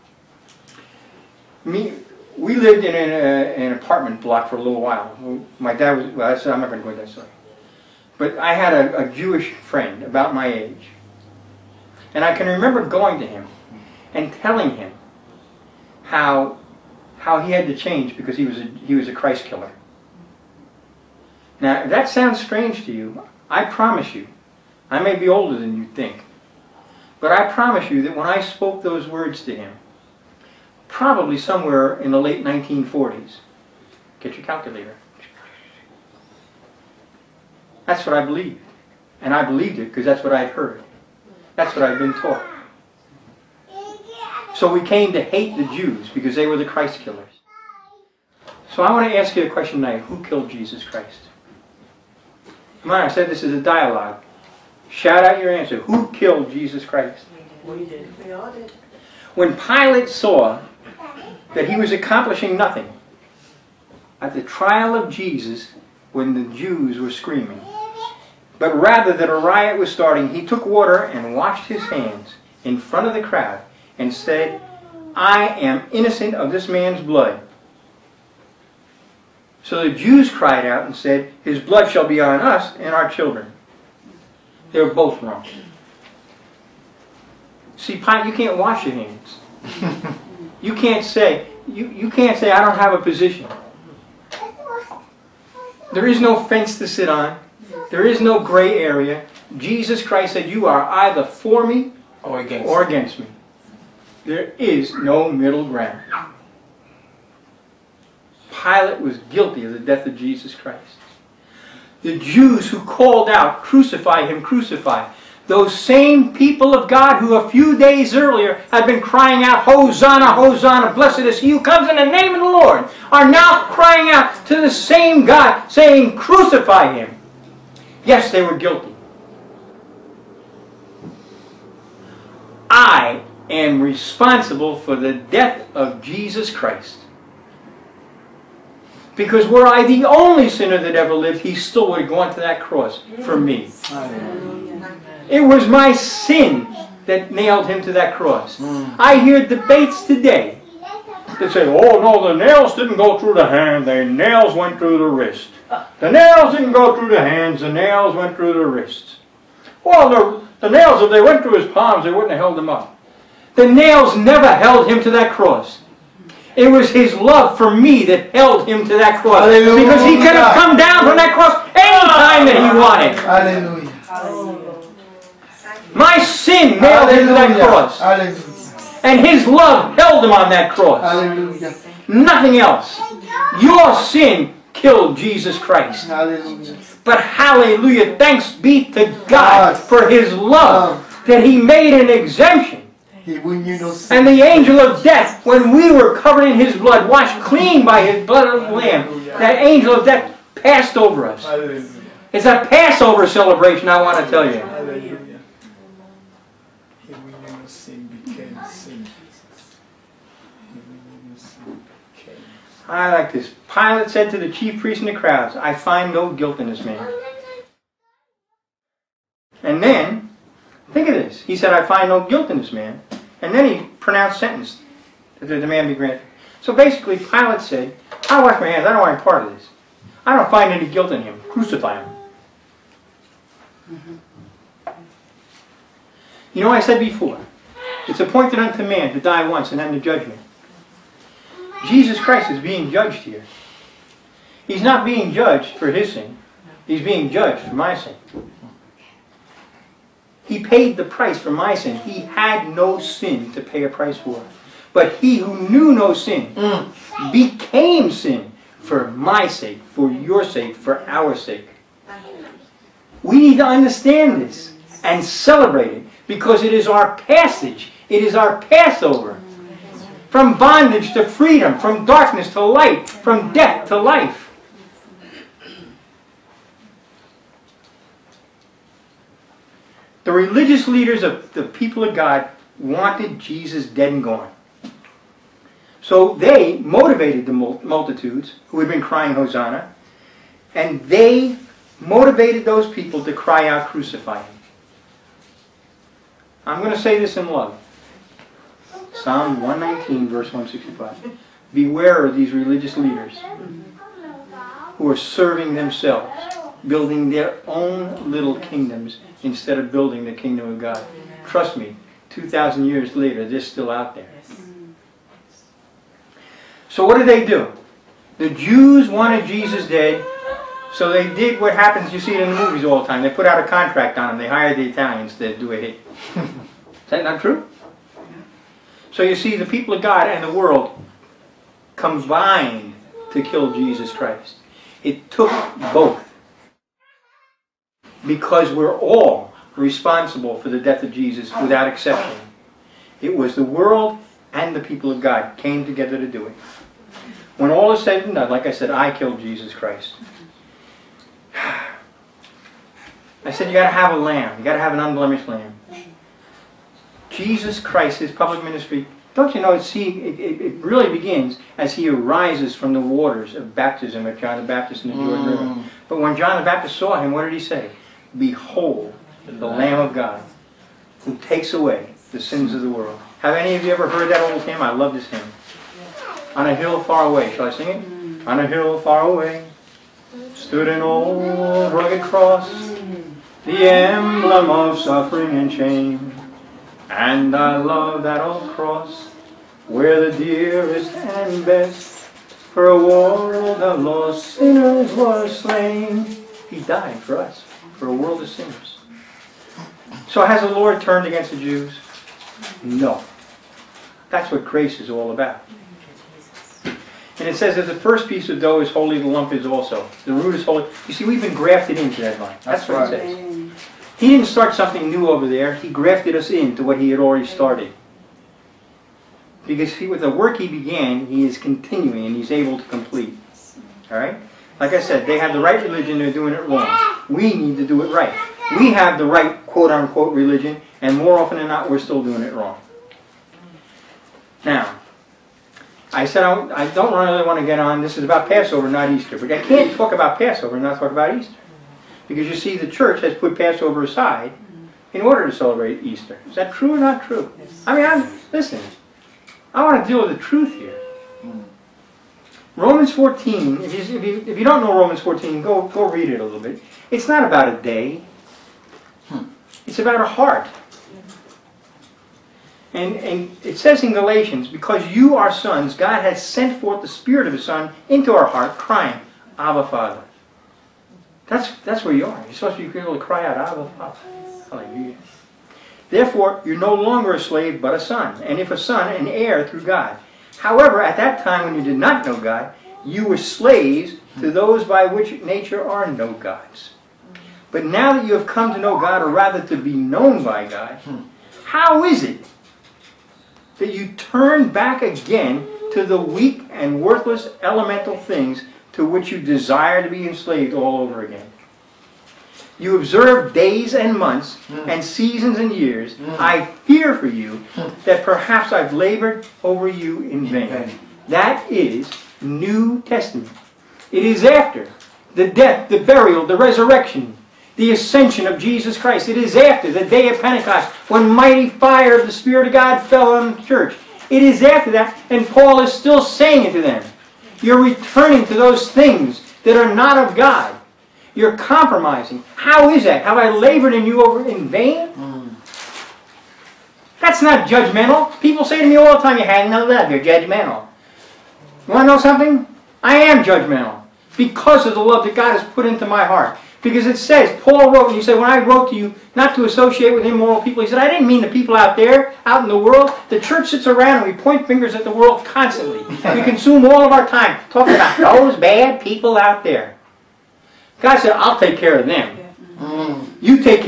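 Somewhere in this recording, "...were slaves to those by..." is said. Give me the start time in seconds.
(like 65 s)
483 s.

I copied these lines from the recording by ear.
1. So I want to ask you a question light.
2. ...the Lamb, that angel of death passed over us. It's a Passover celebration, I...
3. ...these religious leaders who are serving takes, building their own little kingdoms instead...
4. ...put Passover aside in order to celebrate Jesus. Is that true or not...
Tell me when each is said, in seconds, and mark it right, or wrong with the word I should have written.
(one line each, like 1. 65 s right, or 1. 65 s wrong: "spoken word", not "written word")
1. 48 s wrong: "tonight", not "light"
2. 198 s right
3. 302 s wrong: "themselves", not "takes"
4. 443 s wrong: "Easter", not "Jesus".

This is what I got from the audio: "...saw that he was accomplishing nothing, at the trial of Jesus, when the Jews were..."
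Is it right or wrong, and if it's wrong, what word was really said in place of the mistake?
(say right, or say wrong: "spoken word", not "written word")
right.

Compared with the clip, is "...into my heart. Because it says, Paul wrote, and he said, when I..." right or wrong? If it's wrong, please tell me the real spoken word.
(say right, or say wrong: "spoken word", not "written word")
right.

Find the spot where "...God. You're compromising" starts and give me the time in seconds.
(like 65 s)
530 s.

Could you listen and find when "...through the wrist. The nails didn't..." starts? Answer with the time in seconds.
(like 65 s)
154 s.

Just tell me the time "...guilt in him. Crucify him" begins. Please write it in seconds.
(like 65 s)
230 s.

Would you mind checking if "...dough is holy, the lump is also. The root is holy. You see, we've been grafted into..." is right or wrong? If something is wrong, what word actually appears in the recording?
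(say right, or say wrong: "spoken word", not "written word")
right.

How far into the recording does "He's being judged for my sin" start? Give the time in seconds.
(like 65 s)
246 s.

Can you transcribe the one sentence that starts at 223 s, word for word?
And then he pronounced sentence that the demand be granted.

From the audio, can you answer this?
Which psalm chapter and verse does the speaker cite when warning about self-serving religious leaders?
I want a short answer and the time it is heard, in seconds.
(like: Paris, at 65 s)
Psalm 119:165, at 299 s.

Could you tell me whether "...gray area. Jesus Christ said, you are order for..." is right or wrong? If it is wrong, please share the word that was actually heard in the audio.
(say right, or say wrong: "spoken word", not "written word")
wrong: "either", not "order".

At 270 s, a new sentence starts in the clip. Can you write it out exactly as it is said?
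From bondage to freedom, from darkness to light, from death to life.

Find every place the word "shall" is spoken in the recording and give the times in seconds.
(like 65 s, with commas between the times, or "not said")
81 s, 377 s.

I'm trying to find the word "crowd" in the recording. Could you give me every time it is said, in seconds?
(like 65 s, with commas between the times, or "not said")
73 s, 215 s.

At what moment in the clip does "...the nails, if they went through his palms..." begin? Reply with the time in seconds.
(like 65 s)
160 s.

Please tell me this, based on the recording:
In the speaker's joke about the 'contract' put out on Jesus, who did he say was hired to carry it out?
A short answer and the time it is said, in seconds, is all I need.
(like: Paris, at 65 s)
the Italians, at 324 s.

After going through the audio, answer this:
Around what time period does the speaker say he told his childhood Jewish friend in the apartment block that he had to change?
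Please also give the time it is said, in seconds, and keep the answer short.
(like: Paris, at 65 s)
late 1940s, at 32 s.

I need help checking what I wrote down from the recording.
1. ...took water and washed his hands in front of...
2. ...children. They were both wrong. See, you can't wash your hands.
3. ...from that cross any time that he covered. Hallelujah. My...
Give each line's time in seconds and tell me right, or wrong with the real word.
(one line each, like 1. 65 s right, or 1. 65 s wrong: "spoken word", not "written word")
1. 70 s right
2. 83 s right
3. 171 s wrong: "wanted", not "covered".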